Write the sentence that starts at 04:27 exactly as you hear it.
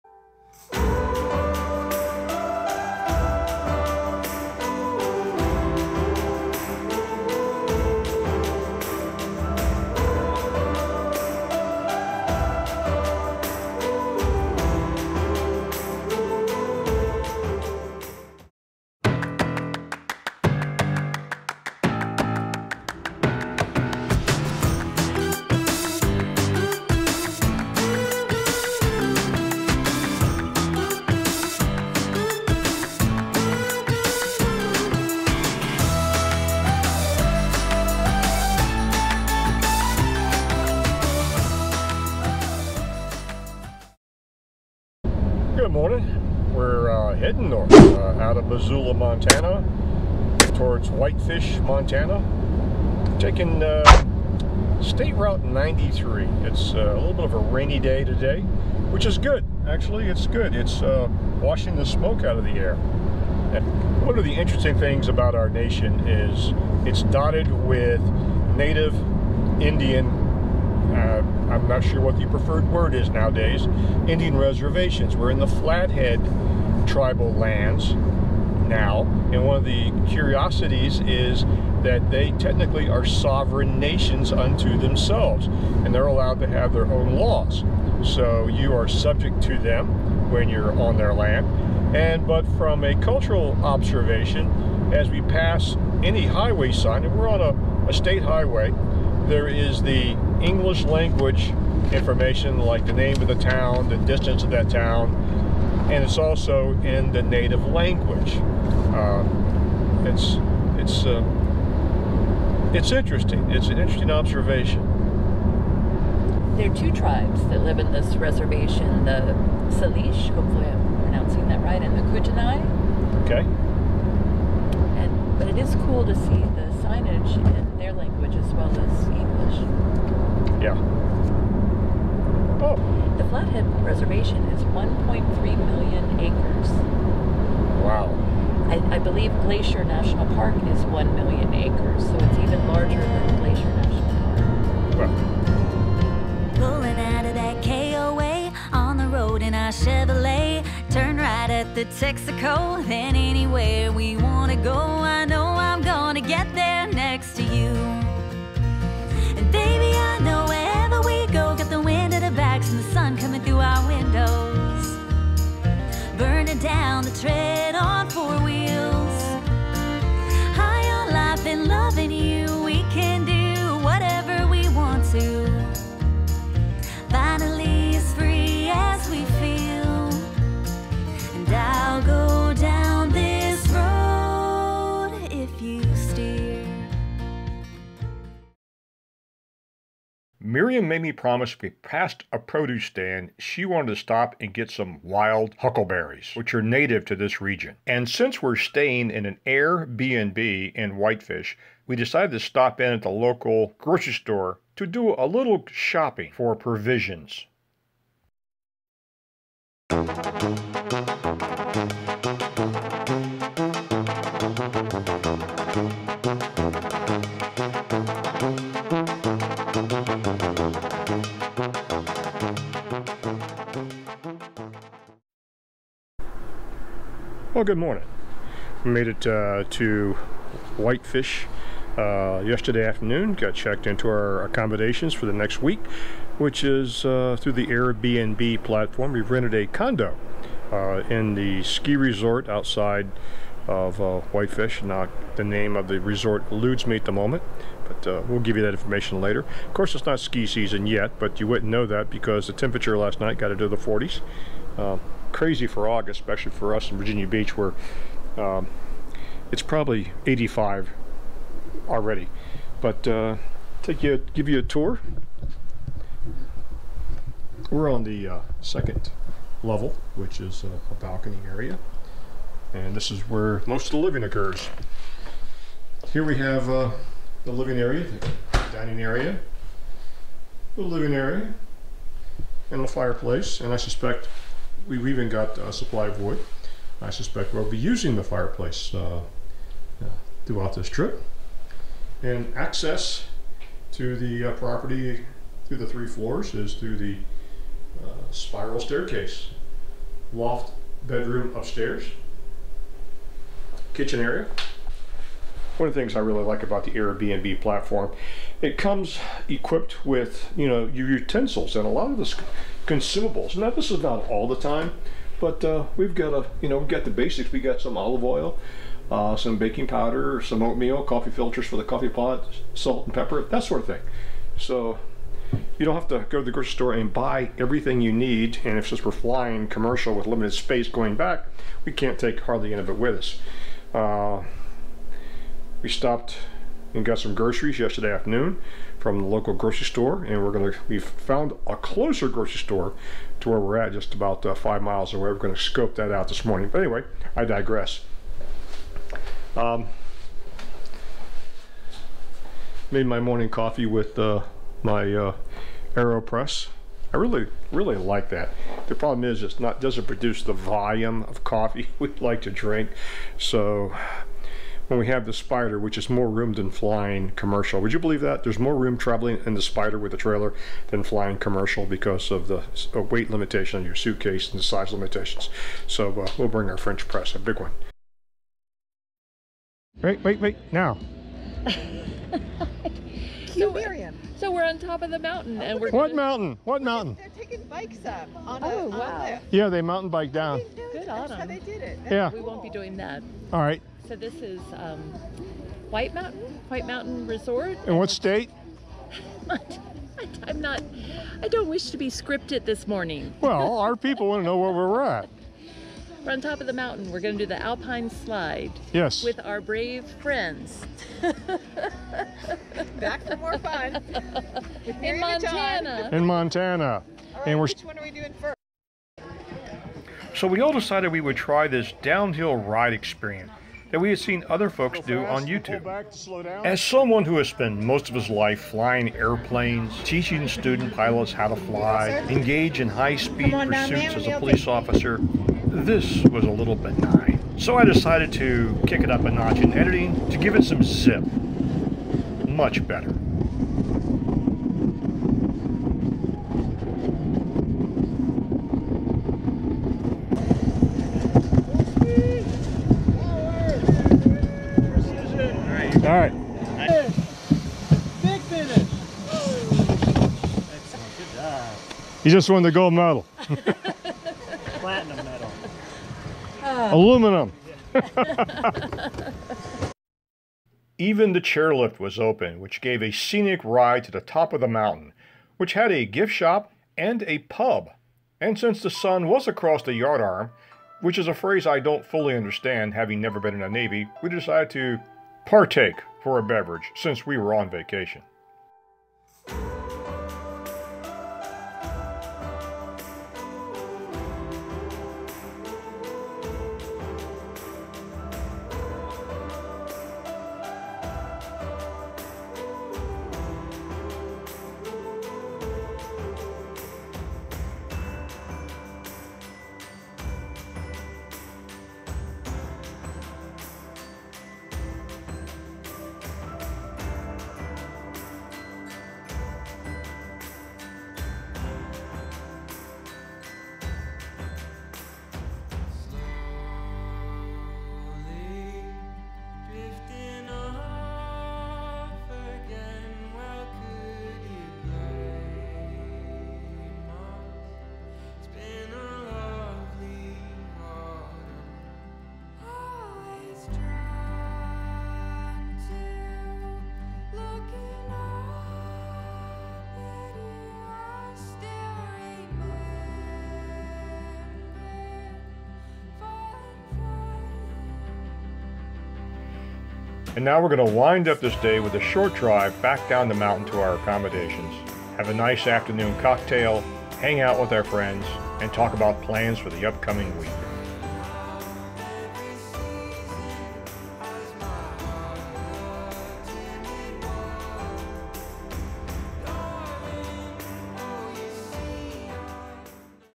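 We're on the uh, second level, which is a, a balcony area, and this is where most of the living occurs.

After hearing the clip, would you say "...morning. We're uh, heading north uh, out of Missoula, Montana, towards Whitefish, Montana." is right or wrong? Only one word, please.
right.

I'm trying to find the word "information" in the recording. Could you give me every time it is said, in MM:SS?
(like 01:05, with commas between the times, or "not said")
01:41, 04:08.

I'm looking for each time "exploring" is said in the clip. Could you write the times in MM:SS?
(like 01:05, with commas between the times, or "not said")
not said.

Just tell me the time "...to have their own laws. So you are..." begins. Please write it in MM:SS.
01:26.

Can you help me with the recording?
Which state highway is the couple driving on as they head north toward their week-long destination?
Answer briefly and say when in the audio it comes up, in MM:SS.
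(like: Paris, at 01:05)
State Route 93, at 00:54.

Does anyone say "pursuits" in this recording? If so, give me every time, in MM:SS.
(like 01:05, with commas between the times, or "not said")
07:13.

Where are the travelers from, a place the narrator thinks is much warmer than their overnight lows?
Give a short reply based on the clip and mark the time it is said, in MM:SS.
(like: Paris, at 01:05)
Virginia Beach, at 04:16.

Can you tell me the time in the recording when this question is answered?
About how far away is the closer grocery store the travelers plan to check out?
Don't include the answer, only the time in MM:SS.
05:44.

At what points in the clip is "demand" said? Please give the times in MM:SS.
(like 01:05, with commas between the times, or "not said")
not said.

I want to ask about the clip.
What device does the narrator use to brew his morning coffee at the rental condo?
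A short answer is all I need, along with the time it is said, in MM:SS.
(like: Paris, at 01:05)
AeroPress, at 05:55.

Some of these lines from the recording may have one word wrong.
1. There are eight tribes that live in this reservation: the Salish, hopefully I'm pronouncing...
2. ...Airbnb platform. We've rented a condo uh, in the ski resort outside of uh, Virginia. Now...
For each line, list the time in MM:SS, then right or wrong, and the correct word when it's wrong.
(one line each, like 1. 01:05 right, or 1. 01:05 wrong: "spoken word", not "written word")
1. 01:56 wrong: "two", not "eight"
2. 03:57 wrong: "Whitefish", not "Virginia".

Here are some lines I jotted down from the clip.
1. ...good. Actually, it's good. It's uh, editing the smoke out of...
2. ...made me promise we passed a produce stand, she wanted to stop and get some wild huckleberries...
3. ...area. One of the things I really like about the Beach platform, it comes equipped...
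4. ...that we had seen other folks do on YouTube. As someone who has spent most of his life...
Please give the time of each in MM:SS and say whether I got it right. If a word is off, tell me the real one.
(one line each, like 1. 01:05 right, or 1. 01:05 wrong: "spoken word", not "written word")
1. 00:59 wrong: "washing", not "editing"
2. 03:10 right
3. 05:04 wrong: "Airbnb", not "Beach"
4. 07:03 right.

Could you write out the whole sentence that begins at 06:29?
On yeah, they mountain bike down good That's how they did it.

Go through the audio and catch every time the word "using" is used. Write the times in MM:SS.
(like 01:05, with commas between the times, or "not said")
04:47.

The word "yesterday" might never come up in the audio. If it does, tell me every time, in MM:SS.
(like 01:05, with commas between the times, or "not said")
03:52, 05:37.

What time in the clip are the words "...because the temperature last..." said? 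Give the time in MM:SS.
04:12.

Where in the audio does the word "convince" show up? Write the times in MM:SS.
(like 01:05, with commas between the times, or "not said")
not said.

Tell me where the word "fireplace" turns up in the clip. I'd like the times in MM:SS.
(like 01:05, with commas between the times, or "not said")
04:42, 04:48.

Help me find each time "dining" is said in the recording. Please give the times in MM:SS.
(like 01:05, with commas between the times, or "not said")
04:38.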